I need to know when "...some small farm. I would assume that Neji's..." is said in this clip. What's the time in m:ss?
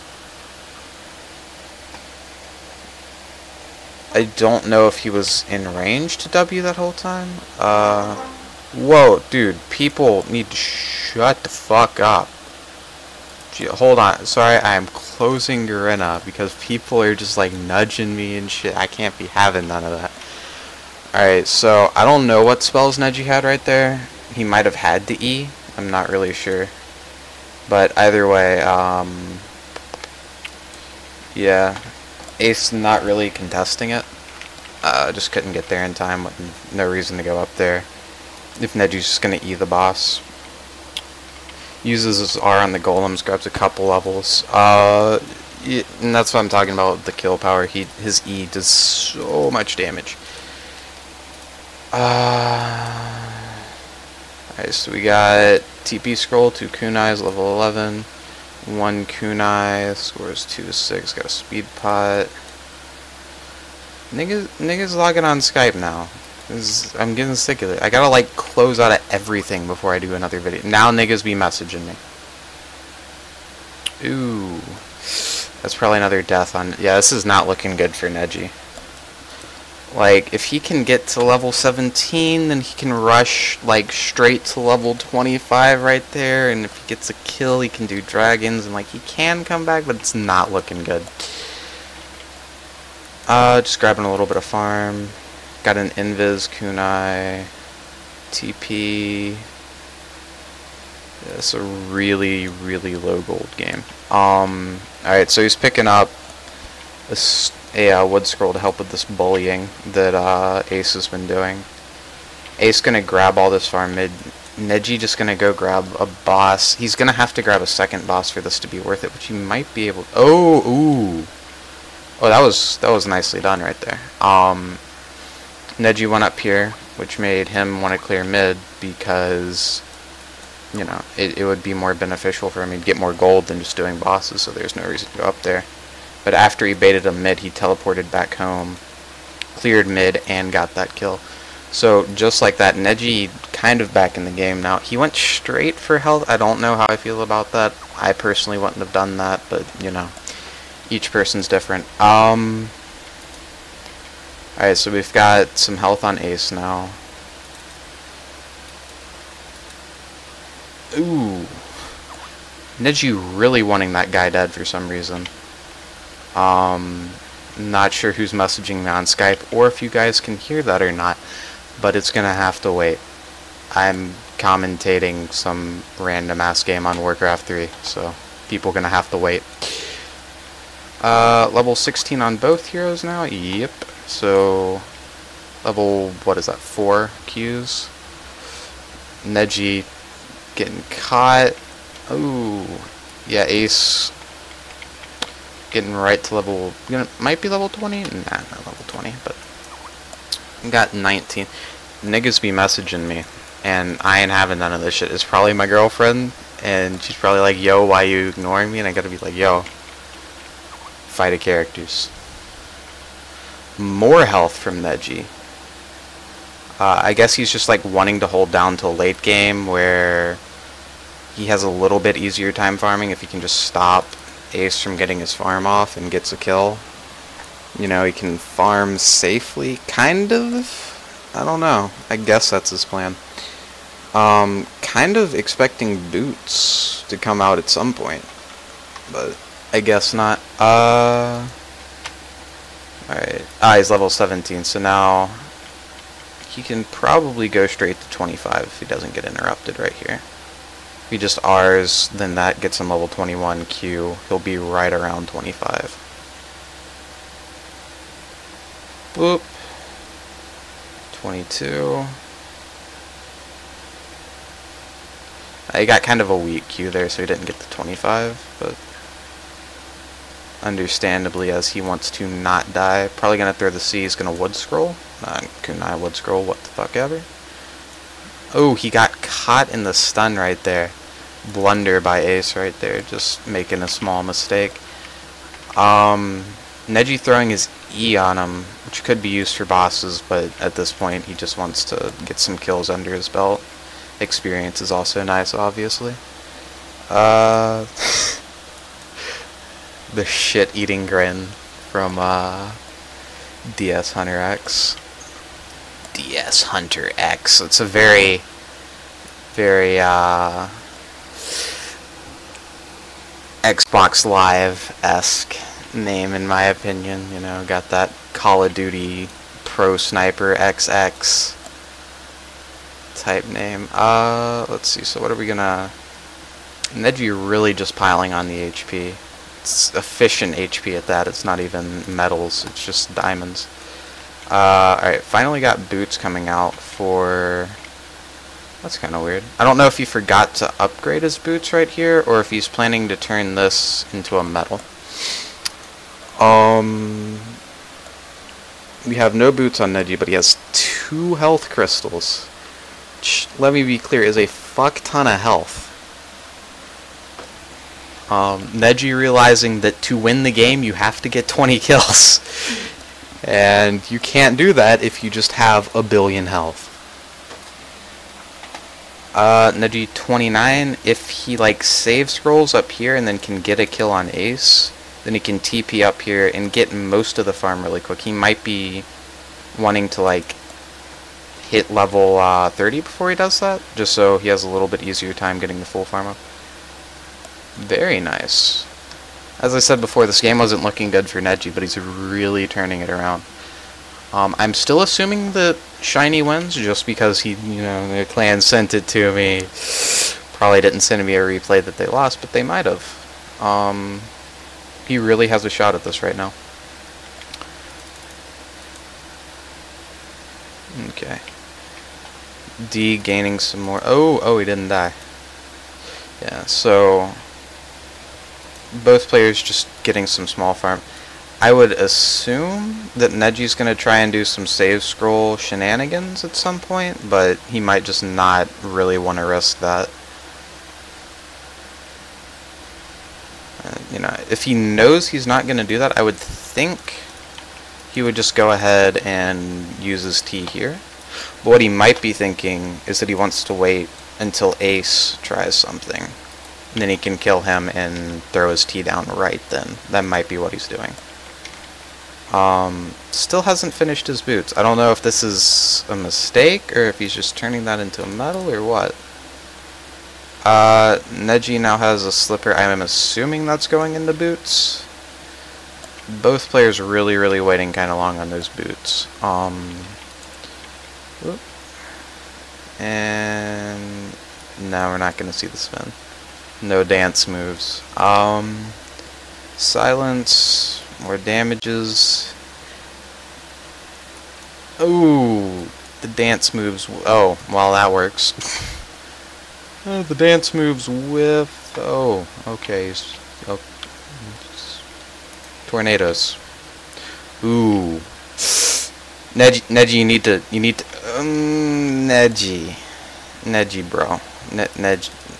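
7:00.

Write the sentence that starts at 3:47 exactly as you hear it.
You know, he can farm safely, kind of?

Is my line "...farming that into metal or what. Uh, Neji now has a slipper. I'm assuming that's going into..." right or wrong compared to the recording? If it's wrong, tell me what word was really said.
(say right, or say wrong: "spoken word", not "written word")
wrong: "turning", not "farming".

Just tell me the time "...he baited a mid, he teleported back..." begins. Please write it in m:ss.
2:16.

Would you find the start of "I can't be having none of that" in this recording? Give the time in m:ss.
0:18.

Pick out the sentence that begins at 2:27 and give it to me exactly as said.
I personally wouldn't have done that, but you know, each person's different.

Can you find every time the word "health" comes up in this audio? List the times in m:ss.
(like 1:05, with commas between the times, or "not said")
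2:25, 2:35, 3:34, 5:51, 5:55, 6:06.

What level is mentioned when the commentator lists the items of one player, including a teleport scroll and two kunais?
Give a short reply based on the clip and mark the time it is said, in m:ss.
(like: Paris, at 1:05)
11, at 0:57.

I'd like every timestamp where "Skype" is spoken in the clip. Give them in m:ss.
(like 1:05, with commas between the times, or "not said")
1:05, 2:49.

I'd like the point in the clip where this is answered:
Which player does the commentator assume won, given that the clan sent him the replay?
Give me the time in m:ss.
6:36.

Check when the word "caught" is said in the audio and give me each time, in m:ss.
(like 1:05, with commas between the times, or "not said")
3:10, 4:39.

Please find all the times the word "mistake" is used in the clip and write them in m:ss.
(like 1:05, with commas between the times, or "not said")
4:44, 7:36.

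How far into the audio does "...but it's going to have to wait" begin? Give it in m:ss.
2:51.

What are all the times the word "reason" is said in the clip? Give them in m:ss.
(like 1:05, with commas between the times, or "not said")
0:36, 2:14, 2:44.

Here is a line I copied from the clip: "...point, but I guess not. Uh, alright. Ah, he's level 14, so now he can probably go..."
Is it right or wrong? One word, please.
wrong.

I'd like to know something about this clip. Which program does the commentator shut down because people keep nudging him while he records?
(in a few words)
Garena.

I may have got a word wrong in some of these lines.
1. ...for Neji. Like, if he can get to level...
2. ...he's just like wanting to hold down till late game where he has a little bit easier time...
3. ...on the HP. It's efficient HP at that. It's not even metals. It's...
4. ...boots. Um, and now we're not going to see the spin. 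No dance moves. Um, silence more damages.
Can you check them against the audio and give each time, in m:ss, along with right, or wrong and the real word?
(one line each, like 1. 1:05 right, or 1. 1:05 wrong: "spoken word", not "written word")
1. 1:17 right
2. 3:37 right
3. 5:28 right
4. 7:48 right.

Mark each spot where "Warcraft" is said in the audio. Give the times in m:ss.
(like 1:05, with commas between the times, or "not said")
2:57.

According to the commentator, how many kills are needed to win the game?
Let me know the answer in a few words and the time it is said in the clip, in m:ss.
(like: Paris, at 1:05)
20, at 6:01.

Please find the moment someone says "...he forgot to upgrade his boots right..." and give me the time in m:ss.
5:39.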